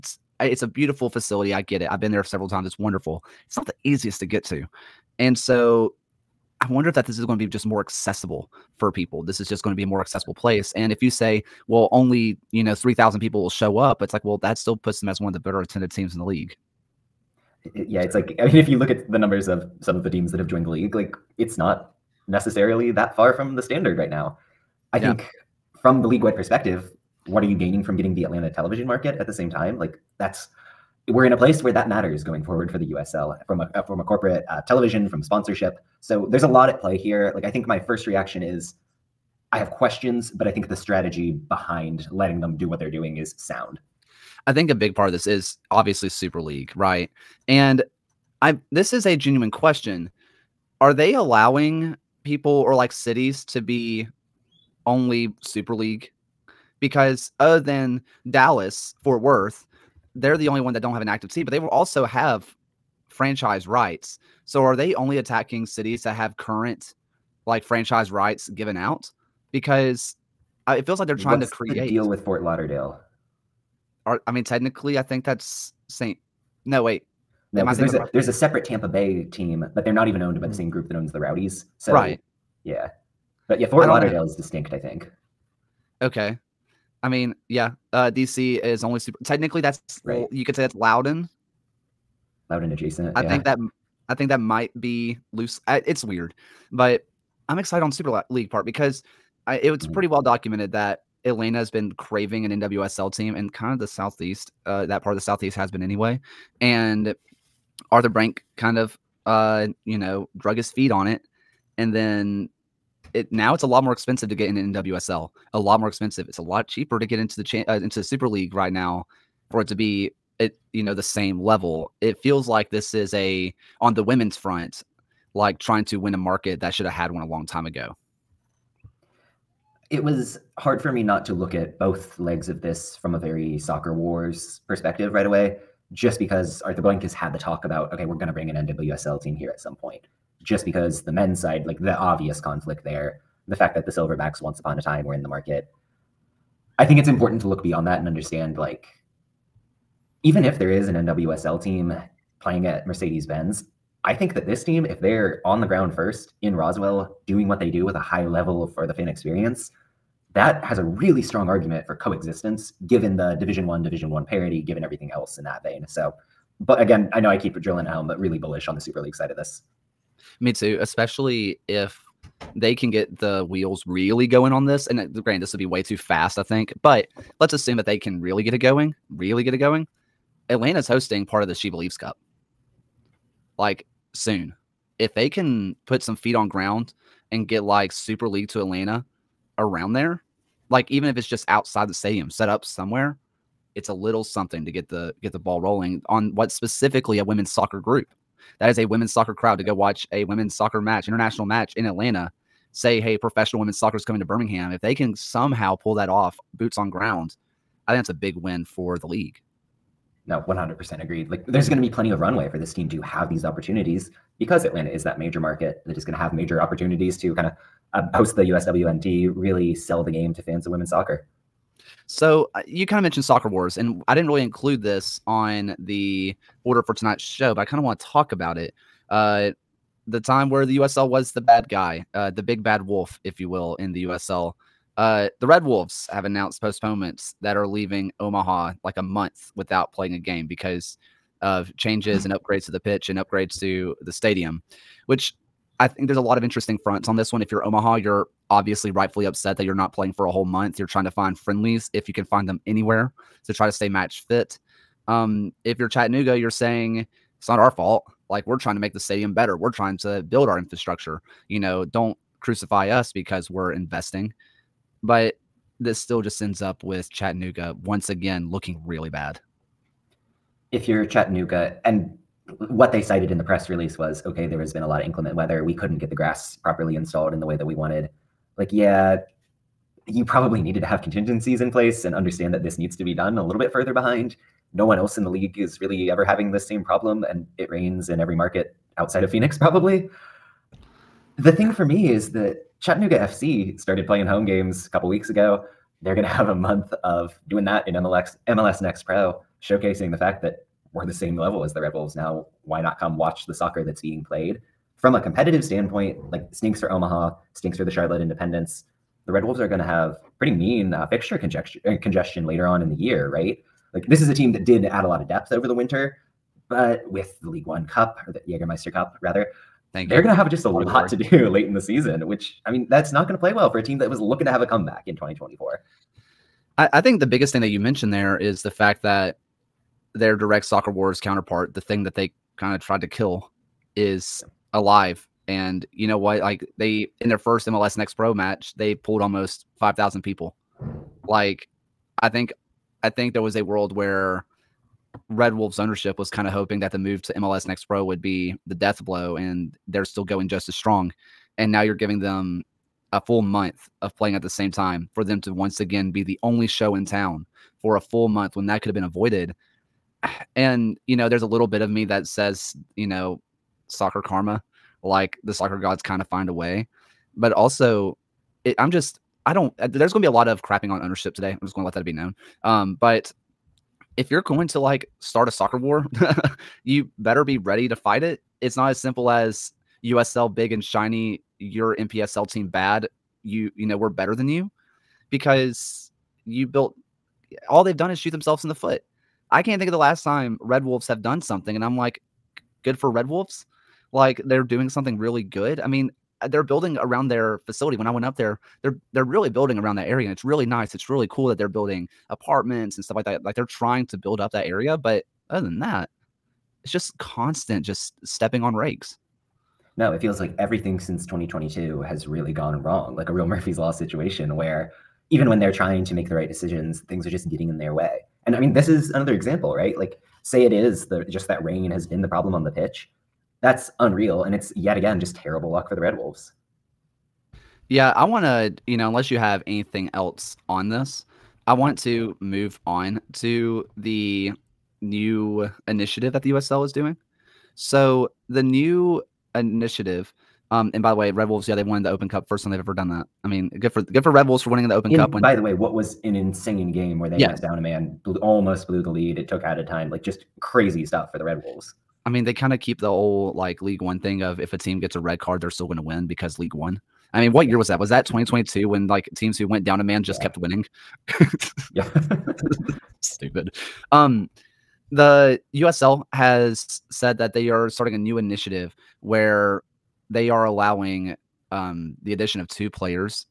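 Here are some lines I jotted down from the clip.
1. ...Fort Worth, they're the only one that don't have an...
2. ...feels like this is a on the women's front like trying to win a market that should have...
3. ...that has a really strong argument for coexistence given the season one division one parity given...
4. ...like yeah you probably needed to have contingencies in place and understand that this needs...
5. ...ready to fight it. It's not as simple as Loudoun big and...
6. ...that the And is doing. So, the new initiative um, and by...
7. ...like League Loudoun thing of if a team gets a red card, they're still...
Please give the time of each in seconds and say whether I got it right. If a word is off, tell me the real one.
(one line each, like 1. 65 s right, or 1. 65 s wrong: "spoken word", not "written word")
1. 59 s right
2. 122 s right
3. 160 s wrong: "division", not "season"
4. 278 s right
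5. 377 s wrong: "USL", not "Loudoun"
6. 436 s wrong: "USL", not "And"
7. 453 s wrong: "One", not "Loudoun".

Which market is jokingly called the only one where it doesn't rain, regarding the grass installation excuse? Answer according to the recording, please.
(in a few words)
Phoenix.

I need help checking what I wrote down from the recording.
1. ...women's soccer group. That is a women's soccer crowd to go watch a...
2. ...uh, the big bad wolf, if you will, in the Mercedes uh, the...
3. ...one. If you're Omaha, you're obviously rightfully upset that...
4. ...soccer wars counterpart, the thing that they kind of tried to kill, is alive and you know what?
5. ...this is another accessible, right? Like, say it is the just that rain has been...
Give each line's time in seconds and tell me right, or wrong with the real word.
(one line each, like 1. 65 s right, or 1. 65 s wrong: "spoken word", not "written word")
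1. 197 s right
2. 232 s wrong: "USL", not "Mercedes"
3. 247 s right
4. 330 s right
5. 418 s wrong: "example", not "accessible".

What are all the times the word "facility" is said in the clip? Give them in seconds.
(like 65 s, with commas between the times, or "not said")
1 s, 397 s.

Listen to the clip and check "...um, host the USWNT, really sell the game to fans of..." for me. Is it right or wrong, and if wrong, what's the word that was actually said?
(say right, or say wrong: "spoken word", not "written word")
right.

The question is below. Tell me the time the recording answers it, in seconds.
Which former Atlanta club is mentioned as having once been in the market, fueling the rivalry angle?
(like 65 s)
143 s.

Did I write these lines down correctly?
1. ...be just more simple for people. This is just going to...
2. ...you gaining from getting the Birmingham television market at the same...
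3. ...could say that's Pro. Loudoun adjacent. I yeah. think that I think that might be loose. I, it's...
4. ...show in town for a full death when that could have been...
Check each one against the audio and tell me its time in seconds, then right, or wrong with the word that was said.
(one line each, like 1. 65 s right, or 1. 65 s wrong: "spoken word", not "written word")
1. 7 s wrong: "accessible", not "simple"
2. 27 s wrong: "Atlanta", not "Birmingham"
3. 90 s wrong: "Loudoun", not "Pro"
4. 356 s wrong: "month", not "death".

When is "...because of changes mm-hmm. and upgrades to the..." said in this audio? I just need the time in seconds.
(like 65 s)
240 s.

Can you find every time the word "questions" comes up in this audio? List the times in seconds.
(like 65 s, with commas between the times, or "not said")
39 s, 49 s.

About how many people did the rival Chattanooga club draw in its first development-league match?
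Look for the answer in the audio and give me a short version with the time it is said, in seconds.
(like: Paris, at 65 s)
5,000, at 339 s.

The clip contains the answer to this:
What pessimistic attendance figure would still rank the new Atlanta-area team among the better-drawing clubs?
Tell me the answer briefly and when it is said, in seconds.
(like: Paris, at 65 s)
3,000, at 12 s.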